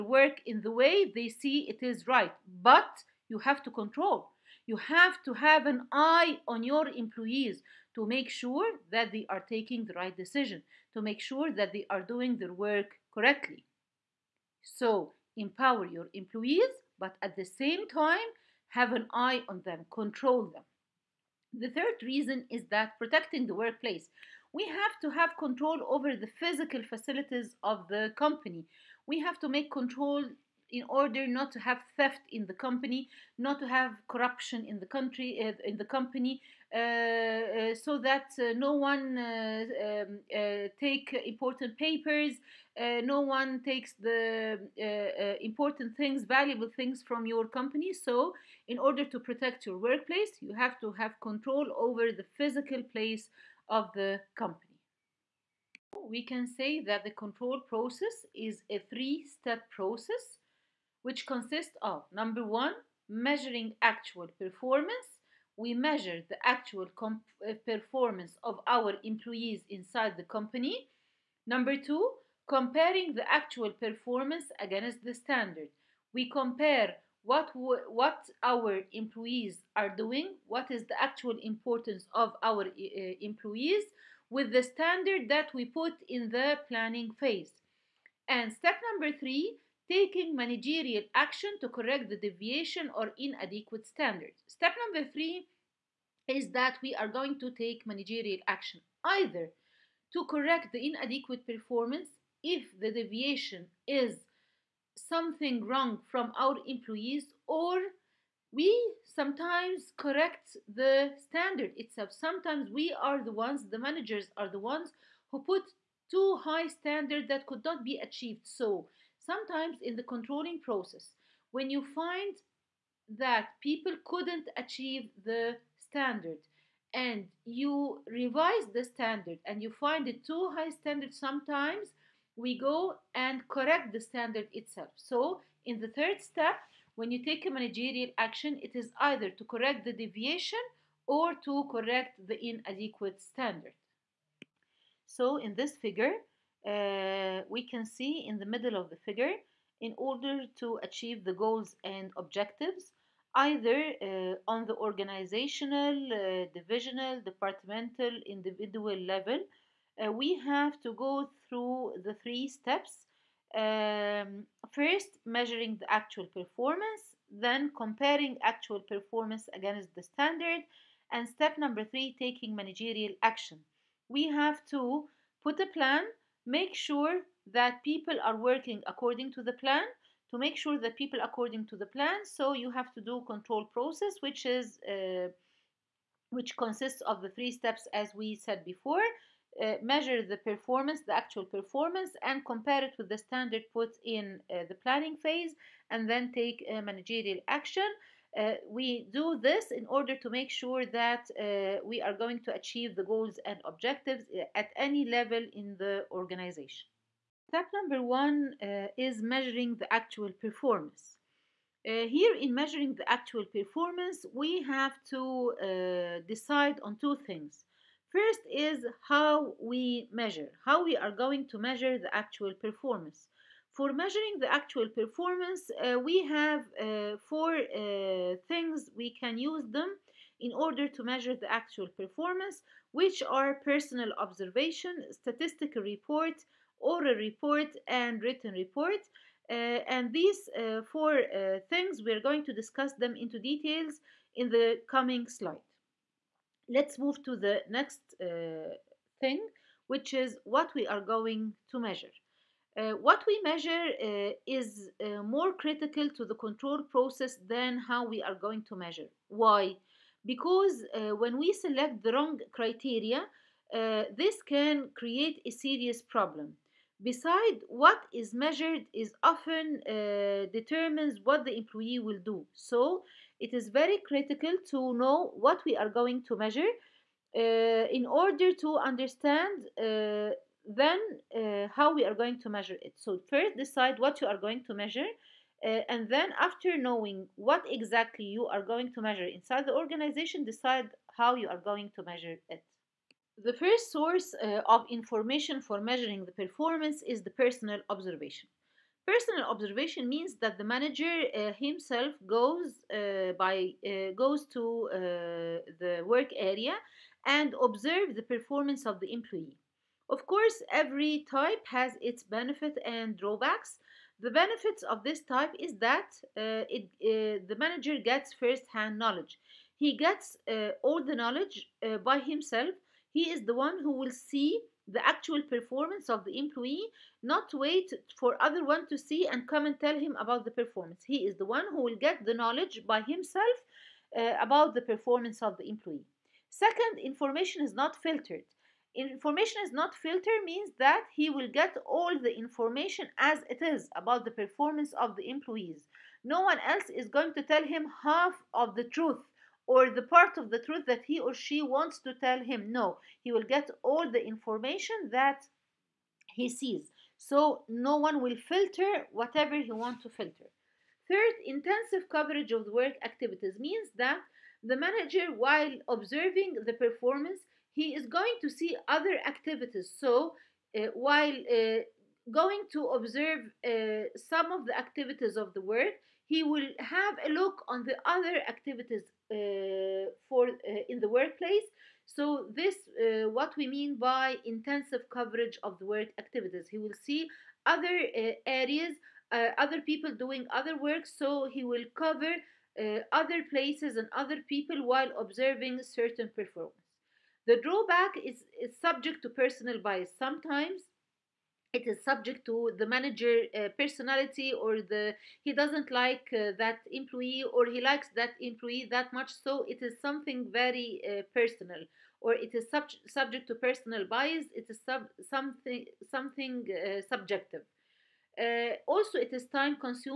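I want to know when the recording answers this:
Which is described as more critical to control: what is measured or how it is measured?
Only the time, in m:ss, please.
4:13.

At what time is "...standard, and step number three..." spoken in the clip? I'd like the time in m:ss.
2:50.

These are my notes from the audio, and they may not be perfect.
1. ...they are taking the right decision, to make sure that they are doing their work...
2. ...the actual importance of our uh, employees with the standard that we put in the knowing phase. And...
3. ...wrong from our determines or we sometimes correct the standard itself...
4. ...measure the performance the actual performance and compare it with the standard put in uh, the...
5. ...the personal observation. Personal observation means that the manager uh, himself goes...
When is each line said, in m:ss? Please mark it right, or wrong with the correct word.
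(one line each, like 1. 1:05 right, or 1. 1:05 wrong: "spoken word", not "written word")
1. 0:09 right
2. 1:20 wrong: "planning", not "knowing"
3. 1:45 wrong: "employees", not "determines"
4. 3:09 right
5. 4:57 right.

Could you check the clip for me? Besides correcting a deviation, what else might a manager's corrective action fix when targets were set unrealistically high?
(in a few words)
inadequate standards.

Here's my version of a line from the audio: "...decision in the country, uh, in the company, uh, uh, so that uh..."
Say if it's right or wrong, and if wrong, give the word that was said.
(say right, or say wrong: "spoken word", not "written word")
wrong: "corruption", not "decision".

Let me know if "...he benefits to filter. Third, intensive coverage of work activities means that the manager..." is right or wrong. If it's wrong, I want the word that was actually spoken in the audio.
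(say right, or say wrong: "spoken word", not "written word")
wrong: "wants", not "benefits".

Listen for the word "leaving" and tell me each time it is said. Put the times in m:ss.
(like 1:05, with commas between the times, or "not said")
not said.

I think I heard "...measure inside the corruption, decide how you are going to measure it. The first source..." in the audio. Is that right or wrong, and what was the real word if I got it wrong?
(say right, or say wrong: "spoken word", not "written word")
wrong: "organization", not "corruption".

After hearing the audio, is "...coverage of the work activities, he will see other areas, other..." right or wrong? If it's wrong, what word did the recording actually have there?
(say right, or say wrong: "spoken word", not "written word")
right.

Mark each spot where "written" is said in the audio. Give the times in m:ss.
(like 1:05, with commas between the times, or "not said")
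3:58.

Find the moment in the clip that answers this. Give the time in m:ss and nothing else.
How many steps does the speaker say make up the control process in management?
0:58.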